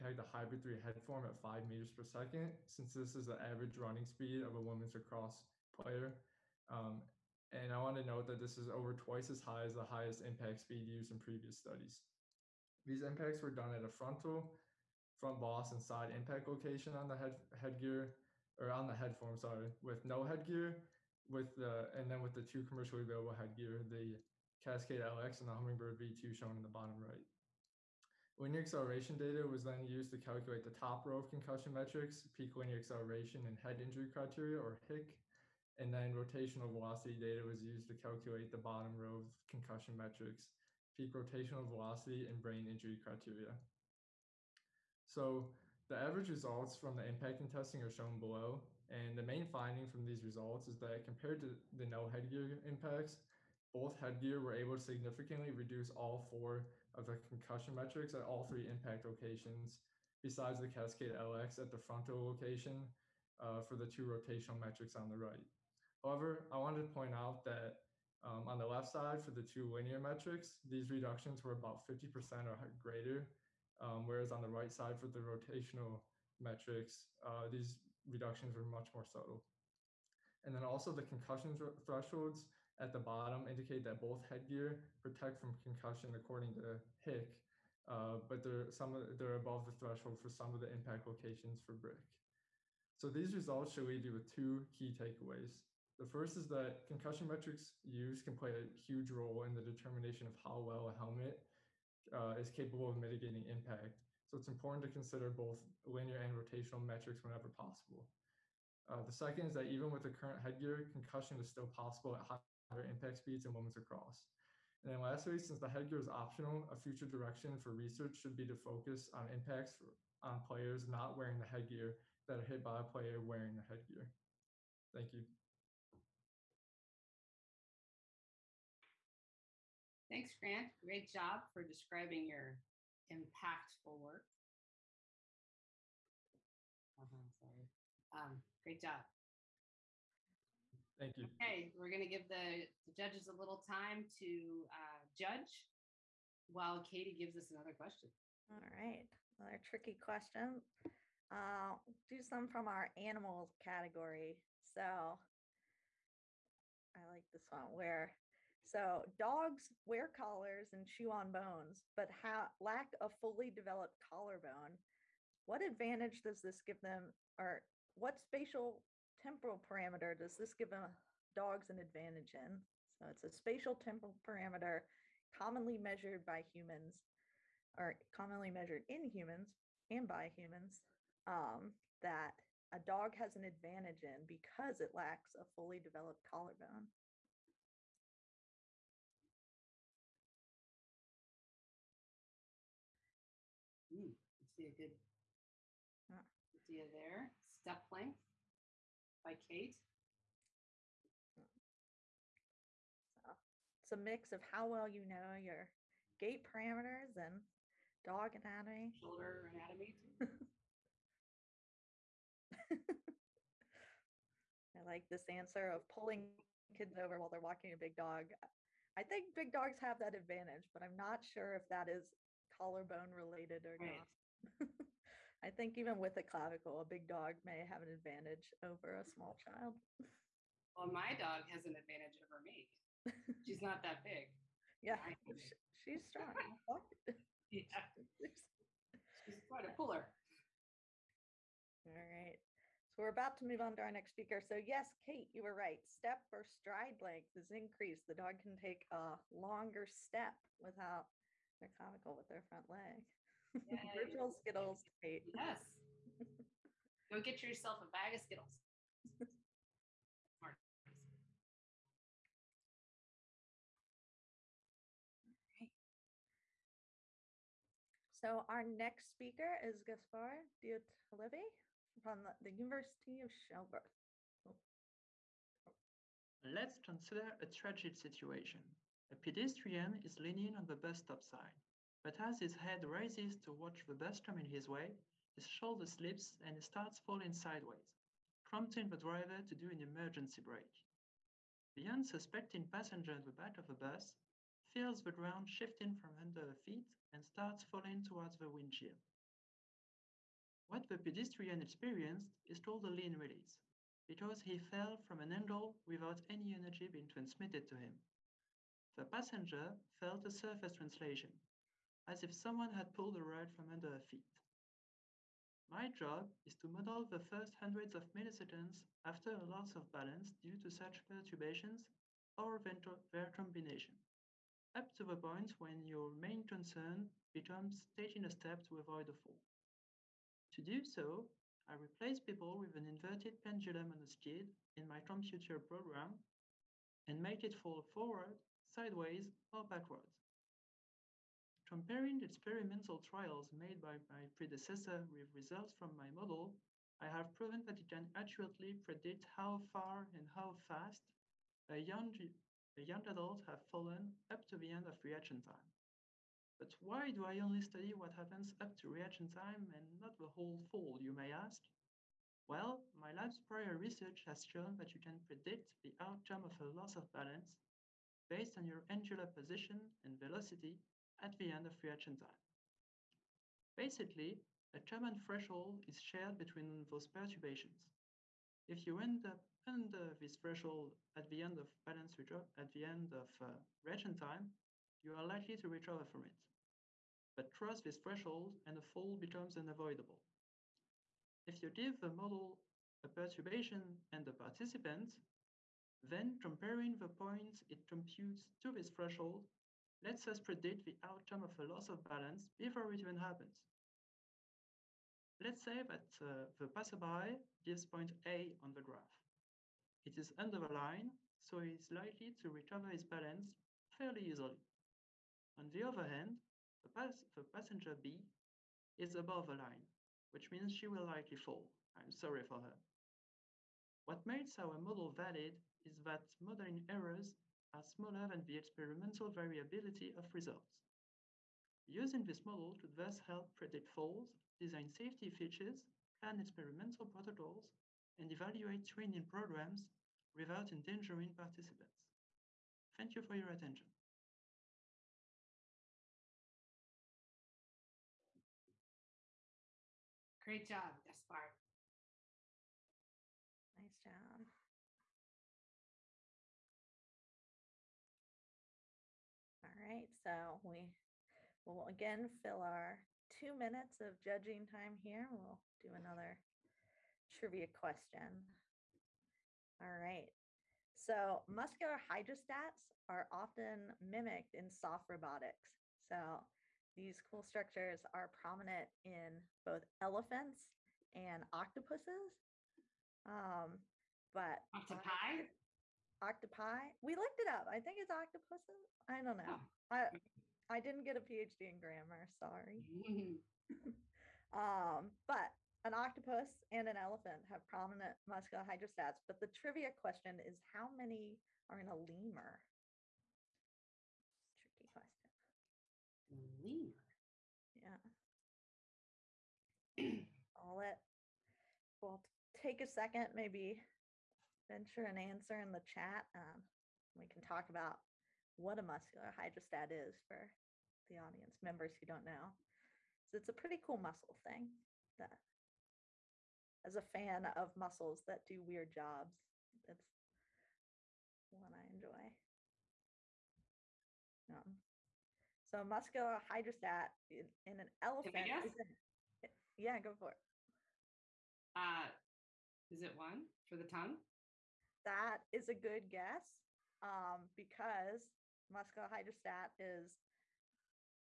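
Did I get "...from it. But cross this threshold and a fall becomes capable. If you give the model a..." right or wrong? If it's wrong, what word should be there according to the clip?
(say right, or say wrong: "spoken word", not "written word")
wrong: "unavoidable", not "capable".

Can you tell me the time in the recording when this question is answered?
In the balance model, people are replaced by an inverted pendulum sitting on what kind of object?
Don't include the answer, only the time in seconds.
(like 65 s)
334 s.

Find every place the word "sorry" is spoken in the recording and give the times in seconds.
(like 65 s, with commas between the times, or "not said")
19 s, 137 s, 422 s, 492 s.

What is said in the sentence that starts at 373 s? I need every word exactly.
Basically, a common threshold is shared between those perturbations.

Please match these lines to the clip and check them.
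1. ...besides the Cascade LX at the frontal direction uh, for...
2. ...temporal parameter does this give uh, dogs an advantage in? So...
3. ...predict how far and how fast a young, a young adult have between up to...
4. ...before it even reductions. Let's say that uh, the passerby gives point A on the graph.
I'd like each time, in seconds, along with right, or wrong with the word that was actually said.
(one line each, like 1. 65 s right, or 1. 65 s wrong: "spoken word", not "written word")
1. 60 s wrong: "location", not "direction"
2. 169 s right
3. 348 s wrong: "fallen", not "between"
4. 402 s wrong: "happens", not "reductions".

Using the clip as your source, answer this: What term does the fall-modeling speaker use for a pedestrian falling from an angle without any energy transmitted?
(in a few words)
lean release.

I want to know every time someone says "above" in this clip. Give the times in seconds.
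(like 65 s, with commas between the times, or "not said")
89 s, 419 s.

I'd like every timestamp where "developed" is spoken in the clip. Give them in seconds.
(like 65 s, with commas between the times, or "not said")
163 s, 185 s.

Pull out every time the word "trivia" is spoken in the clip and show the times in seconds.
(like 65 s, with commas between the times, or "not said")
467 s, 499 s.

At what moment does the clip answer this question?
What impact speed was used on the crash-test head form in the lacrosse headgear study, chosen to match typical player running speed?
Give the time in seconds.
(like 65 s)
1 s.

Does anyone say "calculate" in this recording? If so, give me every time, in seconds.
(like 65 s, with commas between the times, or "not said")
30 s, 37 s.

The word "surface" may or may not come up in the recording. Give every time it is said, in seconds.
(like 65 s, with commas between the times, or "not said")
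310 s.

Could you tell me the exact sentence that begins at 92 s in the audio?
So these results should leave you with two key takeaways.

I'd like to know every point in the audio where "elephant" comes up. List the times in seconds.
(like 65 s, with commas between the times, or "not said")
479 s, 496 s, 537 s.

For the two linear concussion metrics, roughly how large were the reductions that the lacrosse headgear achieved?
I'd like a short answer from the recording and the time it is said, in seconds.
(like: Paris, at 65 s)
50% or greater, at 71 s.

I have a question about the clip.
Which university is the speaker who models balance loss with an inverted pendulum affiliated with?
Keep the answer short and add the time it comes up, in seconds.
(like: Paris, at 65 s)
University of Sherbrooke, at 272 s.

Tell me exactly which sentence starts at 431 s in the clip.
Using this model could thus help predict falls, design safety features, plan experimental protocols, and evaluate training programs without endangering participants.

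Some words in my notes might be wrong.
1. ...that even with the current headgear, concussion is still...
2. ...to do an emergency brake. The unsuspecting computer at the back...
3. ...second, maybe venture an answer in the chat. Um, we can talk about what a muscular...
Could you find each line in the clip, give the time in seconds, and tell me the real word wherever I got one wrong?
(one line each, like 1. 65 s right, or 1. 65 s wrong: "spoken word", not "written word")
1. 109 s right
2. 289 s wrong: "passenger", not "computer"
3. 512 s right.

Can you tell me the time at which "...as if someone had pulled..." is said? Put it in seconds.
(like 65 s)
312 s.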